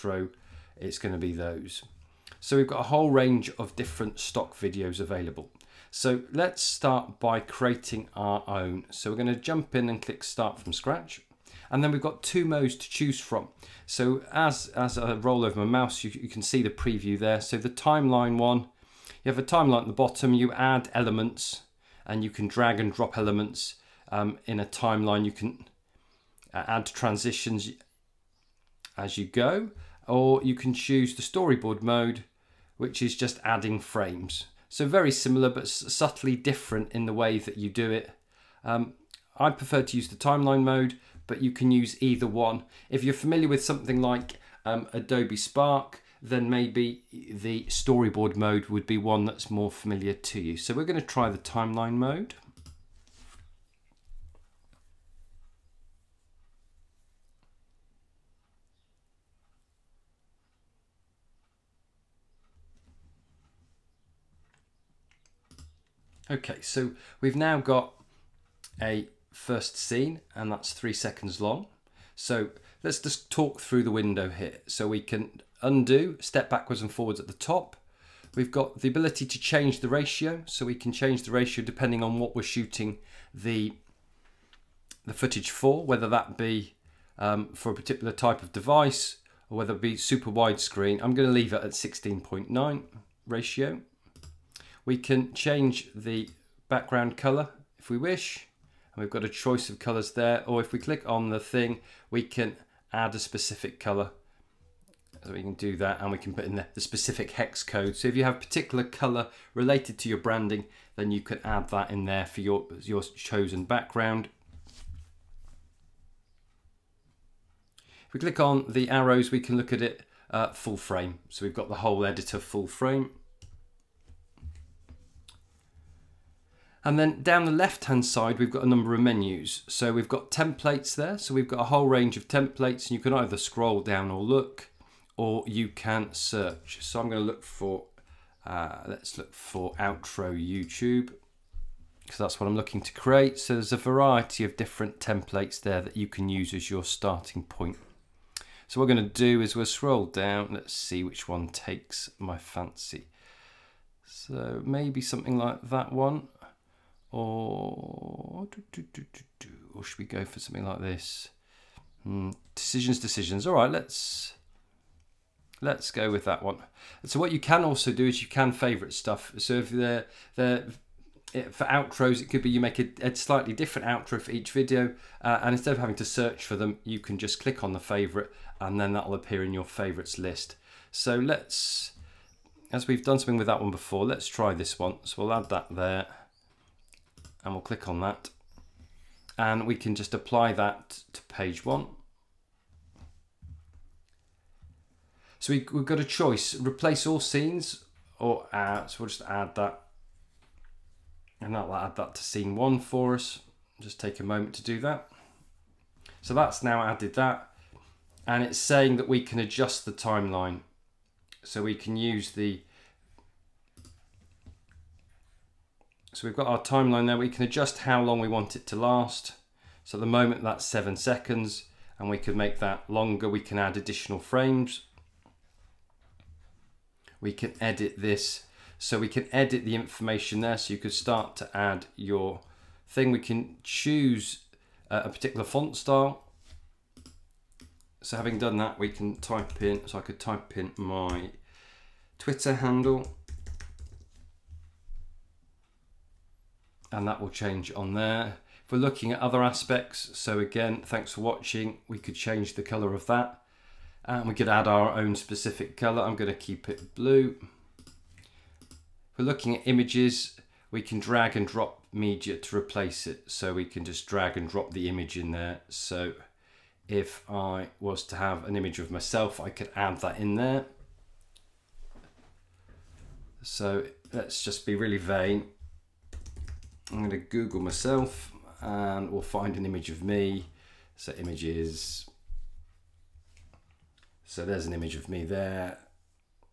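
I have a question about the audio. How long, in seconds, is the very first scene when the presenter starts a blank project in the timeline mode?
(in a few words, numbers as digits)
3 seconds.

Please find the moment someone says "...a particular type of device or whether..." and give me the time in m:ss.
1:27.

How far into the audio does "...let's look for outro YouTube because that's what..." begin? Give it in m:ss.
2:18.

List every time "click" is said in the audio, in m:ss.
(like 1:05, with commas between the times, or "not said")
0:10, 1:40, 1:58, 2:57, 3:07.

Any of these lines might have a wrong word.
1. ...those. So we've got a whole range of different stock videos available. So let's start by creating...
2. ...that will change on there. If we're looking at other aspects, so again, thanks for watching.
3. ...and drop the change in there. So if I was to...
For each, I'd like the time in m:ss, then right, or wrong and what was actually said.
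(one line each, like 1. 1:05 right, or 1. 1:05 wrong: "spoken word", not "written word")
1. 0:01 right
2. 4:07 right
3. 4:24 wrong: "image", not "change".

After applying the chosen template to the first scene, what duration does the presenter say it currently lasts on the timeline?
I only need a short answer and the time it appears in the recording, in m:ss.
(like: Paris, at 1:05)
7 seconds, at 3:40.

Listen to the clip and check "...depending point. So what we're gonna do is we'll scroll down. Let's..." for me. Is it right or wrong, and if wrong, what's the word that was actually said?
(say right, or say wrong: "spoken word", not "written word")
wrong: "starting", not "depending".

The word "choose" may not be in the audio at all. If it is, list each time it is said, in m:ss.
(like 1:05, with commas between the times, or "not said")
0:12, 0:30, 3:53.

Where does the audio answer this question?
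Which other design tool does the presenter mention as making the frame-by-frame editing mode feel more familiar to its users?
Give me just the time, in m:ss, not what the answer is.
0:44.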